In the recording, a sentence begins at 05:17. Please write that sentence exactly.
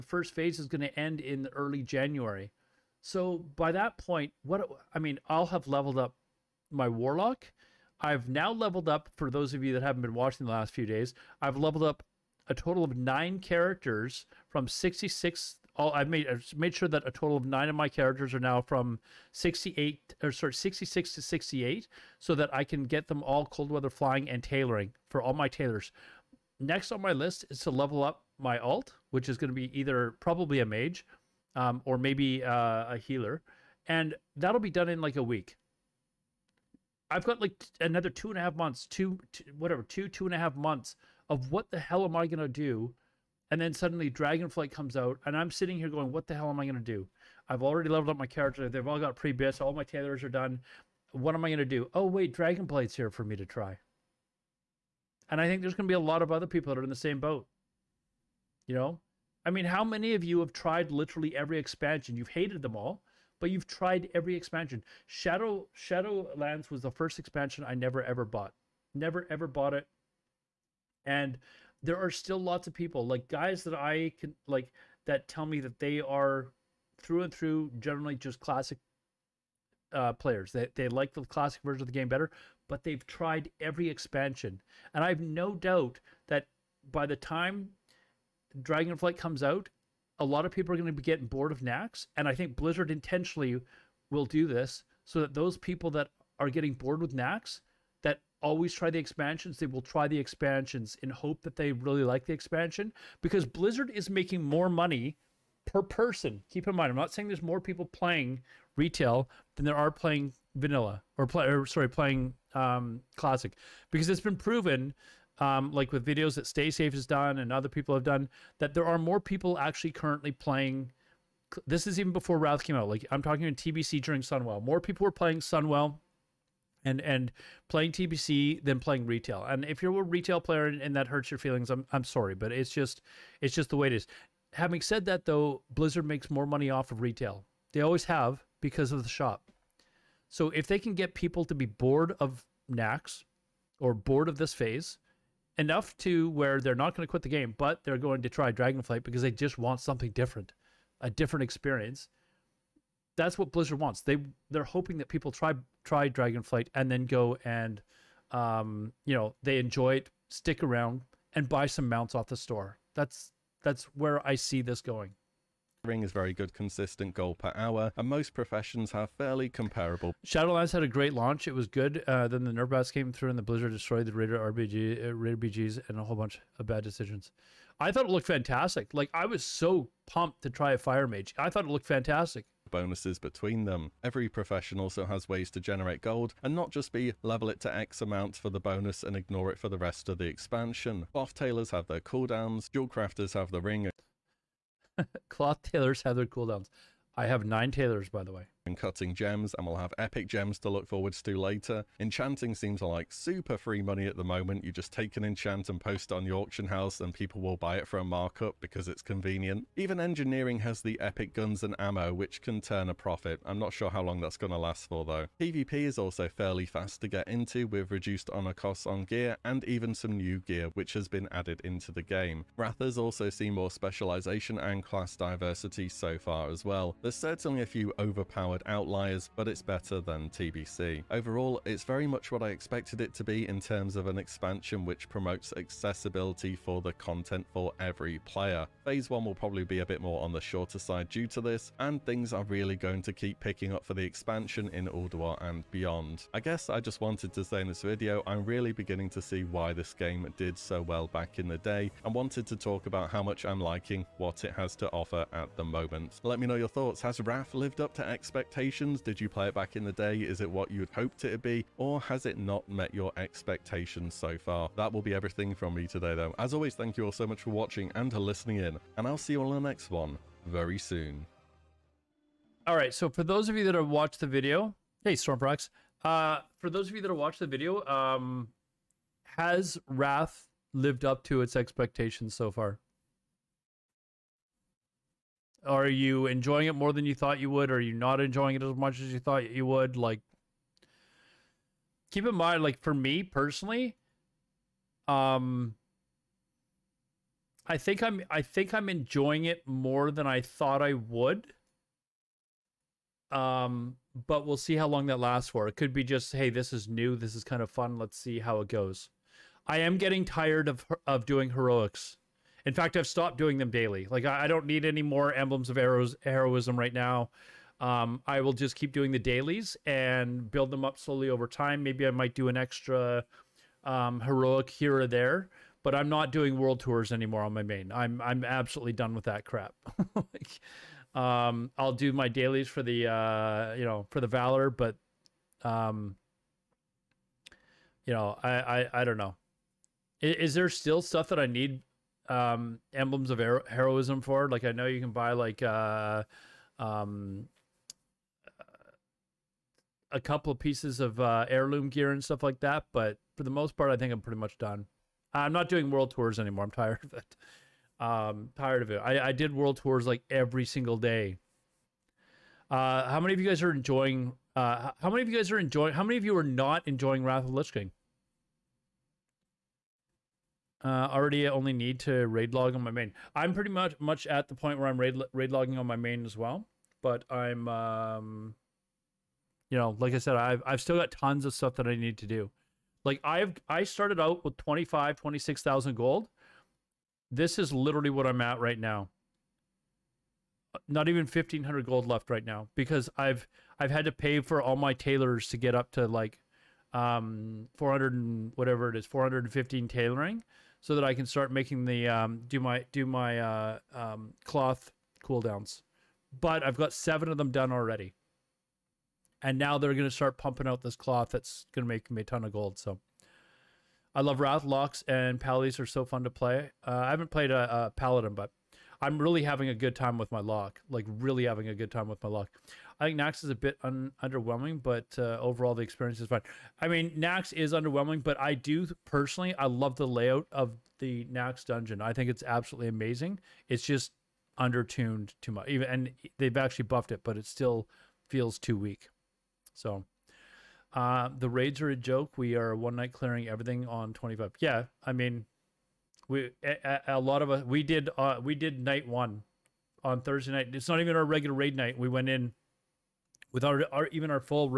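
Um, I will just keep doing the dailies and build them up slowly over time.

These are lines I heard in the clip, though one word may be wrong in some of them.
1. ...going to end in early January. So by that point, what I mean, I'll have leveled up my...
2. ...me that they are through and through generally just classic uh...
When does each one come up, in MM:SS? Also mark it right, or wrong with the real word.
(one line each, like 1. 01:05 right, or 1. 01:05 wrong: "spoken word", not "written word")
1. 00:00 right
2. 01:15 right.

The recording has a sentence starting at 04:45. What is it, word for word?
Are you enjoying it more than you thought you would?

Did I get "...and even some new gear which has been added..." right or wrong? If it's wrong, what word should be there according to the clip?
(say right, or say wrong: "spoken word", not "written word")
right.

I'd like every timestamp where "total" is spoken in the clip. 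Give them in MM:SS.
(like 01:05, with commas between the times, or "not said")
00:12, 00:17.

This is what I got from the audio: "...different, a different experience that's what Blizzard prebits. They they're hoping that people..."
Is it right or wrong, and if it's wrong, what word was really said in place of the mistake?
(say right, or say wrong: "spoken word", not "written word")
wrong: "wants", not "prebits".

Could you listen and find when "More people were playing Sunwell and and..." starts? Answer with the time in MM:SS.
02:04.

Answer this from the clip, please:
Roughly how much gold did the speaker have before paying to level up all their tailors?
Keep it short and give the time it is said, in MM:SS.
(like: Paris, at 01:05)
26,000 gold, at 06:25.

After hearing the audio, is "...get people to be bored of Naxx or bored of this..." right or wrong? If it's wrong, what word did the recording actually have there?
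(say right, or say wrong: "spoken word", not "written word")
right.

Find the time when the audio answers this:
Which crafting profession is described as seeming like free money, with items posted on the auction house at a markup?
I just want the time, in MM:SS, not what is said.
03:21.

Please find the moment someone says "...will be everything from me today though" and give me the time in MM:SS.
04:24.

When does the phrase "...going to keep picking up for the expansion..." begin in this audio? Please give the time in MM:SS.
04:02.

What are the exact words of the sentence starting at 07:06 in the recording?
I mean, Naxx is underwhelming, but I do personally I love the layout of the Naxx dungeon.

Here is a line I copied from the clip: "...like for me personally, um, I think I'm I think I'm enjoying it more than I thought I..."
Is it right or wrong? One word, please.
right.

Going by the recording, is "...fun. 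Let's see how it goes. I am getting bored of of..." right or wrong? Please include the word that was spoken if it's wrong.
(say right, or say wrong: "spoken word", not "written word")
wrong: "tired", not "bored".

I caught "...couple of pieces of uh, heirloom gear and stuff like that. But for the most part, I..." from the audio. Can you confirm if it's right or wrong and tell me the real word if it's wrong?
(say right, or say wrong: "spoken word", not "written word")
right.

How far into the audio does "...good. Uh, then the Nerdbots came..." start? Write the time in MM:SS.
02:51.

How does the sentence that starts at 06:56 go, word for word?
Uh, I haven't played a, a Paladin, but I'm really having a good time with my lock.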